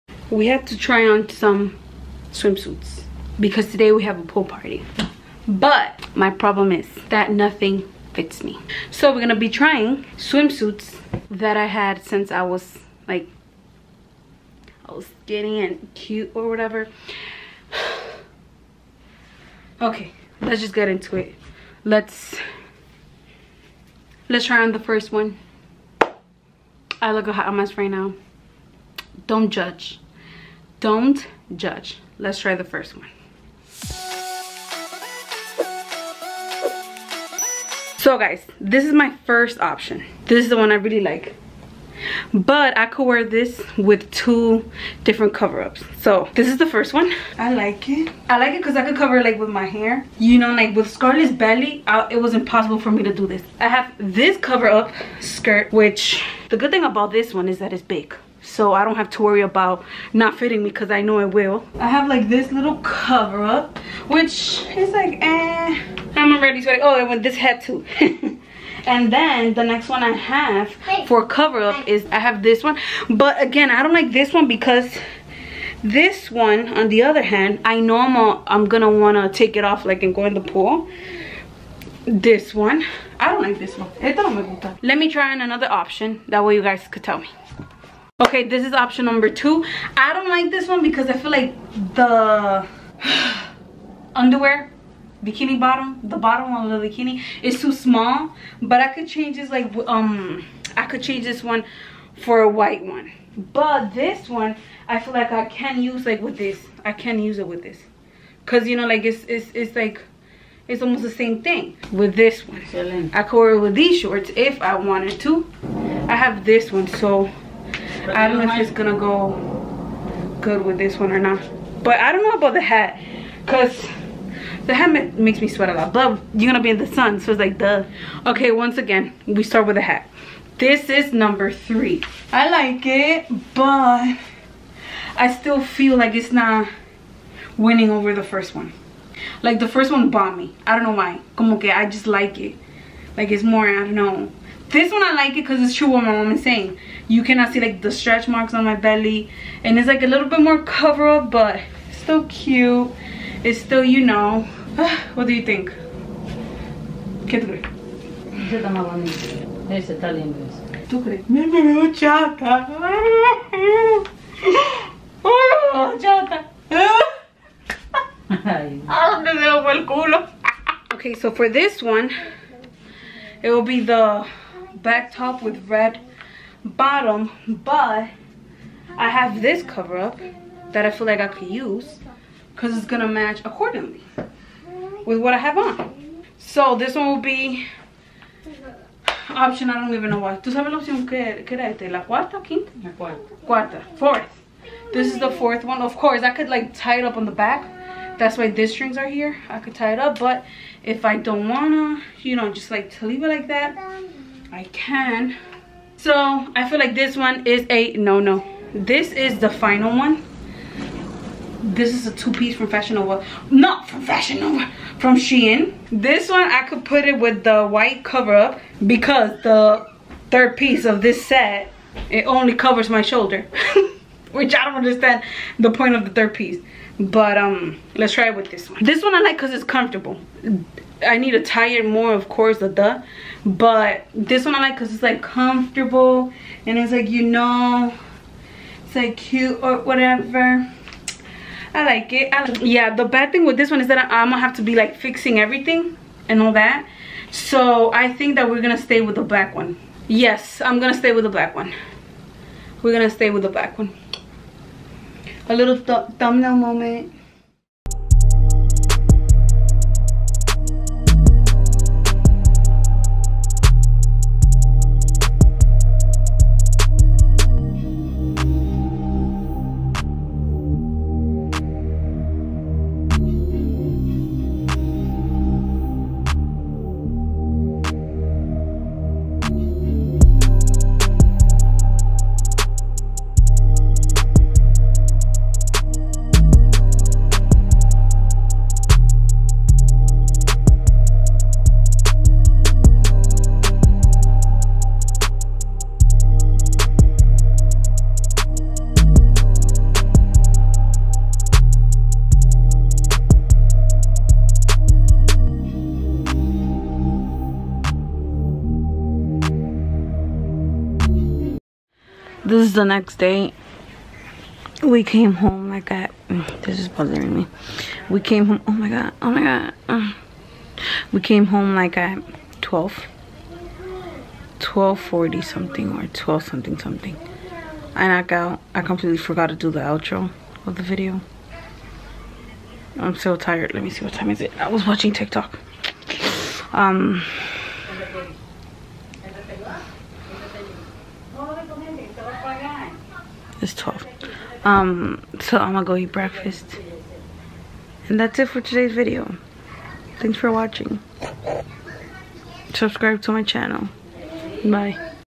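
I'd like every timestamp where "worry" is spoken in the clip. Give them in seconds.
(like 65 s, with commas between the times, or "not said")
59 s.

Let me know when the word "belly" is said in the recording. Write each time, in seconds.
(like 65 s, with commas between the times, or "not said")
51 s, 148 s.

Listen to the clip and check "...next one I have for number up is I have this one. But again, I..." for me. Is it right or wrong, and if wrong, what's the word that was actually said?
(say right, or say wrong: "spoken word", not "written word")
wrong: "cover", not "number".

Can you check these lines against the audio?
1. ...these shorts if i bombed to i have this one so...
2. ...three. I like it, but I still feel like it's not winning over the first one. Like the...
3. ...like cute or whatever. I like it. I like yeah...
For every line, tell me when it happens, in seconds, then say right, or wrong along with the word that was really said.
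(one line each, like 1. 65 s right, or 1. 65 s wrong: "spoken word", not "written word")
1. 113 s wrong: "wanted", not "bombed"
2. 131 s right
3. 238 s right.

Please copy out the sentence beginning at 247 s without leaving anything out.
So I think that we're gonna stay with the black one.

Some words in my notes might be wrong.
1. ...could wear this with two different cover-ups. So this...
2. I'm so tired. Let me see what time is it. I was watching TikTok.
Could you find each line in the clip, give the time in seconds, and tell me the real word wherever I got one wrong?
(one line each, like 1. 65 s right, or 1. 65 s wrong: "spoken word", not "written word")
1. 42 s right
2. 332 s right.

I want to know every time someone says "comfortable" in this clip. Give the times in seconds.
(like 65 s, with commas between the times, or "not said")
229 s, 235 s.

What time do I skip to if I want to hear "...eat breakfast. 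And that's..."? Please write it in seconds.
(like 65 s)
345 s.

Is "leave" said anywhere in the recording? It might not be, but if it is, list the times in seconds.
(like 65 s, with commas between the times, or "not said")
203 s.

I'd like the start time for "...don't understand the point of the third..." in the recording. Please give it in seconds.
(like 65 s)
224 s.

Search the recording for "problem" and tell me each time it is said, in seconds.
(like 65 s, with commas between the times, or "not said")
6 s.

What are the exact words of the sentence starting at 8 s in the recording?
So we're gonna be trying swimsuits that I had since I was like, I was skinny and cute or whatever.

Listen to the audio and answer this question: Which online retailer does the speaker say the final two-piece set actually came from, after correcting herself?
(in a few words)
Shein.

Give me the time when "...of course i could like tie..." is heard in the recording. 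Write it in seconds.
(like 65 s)
195 s.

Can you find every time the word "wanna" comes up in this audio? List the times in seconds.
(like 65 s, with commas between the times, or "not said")
78 s, 201 s.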